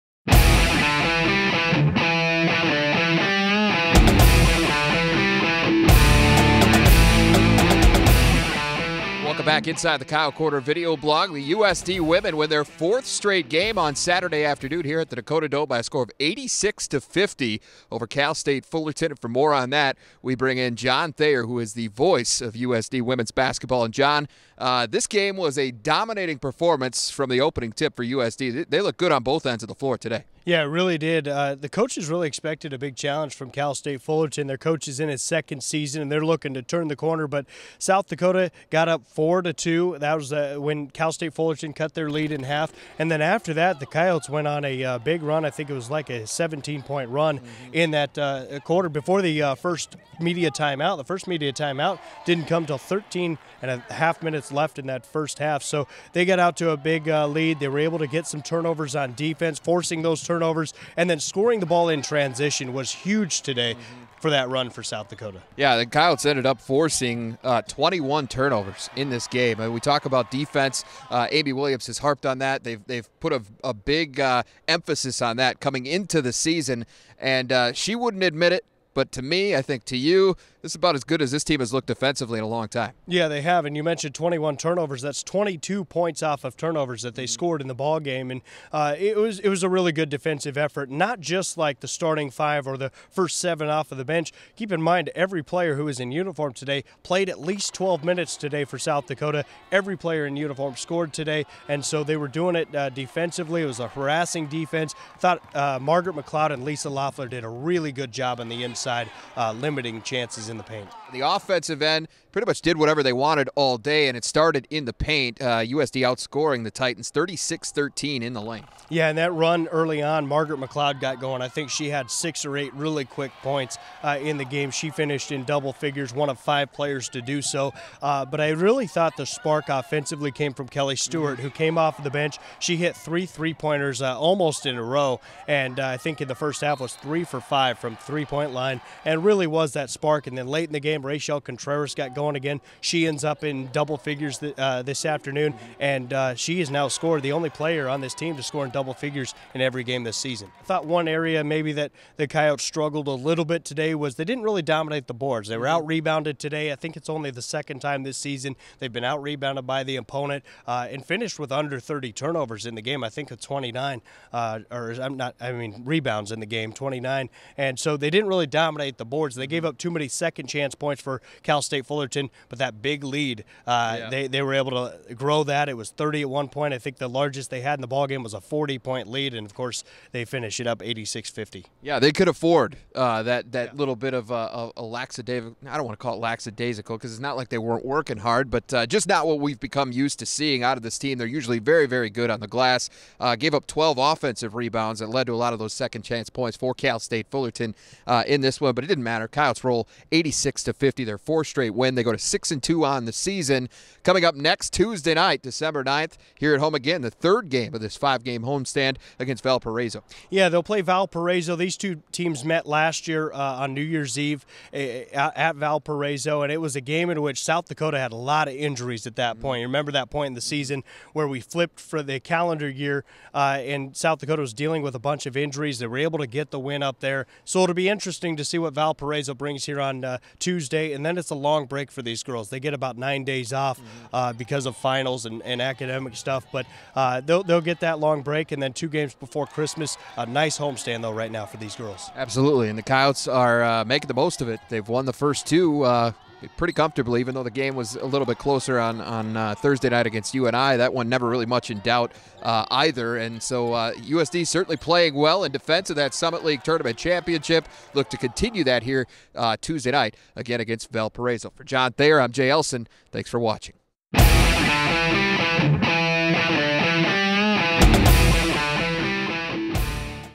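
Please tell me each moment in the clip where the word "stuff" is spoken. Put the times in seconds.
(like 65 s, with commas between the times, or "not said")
236 s.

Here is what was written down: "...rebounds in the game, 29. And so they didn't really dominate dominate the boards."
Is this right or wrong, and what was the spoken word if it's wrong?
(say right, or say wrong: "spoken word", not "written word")
right.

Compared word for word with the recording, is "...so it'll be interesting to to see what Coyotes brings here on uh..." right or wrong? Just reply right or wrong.
wrong.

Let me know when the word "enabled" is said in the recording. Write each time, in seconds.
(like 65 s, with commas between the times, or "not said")
not said.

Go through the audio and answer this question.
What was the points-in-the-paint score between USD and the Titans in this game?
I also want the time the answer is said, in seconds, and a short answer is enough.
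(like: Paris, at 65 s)
36-13, at 117 s.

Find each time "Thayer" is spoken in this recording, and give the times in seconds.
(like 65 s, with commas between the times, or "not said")
21 s, 261 s.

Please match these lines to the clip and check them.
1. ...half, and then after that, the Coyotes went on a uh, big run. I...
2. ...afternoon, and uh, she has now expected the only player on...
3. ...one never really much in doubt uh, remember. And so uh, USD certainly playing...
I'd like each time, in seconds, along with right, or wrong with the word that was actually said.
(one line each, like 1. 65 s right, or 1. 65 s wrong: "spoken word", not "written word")
1. 42 s right
2. 145 s wrong: "scored", not "expected"
3. 250 s wrong: "either", not "remember".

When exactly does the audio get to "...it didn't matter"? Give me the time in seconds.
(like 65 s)
198 s.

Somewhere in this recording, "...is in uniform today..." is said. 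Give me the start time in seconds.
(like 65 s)
95 s.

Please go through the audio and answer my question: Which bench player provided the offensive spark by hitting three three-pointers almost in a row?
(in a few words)
Kelly Stewart.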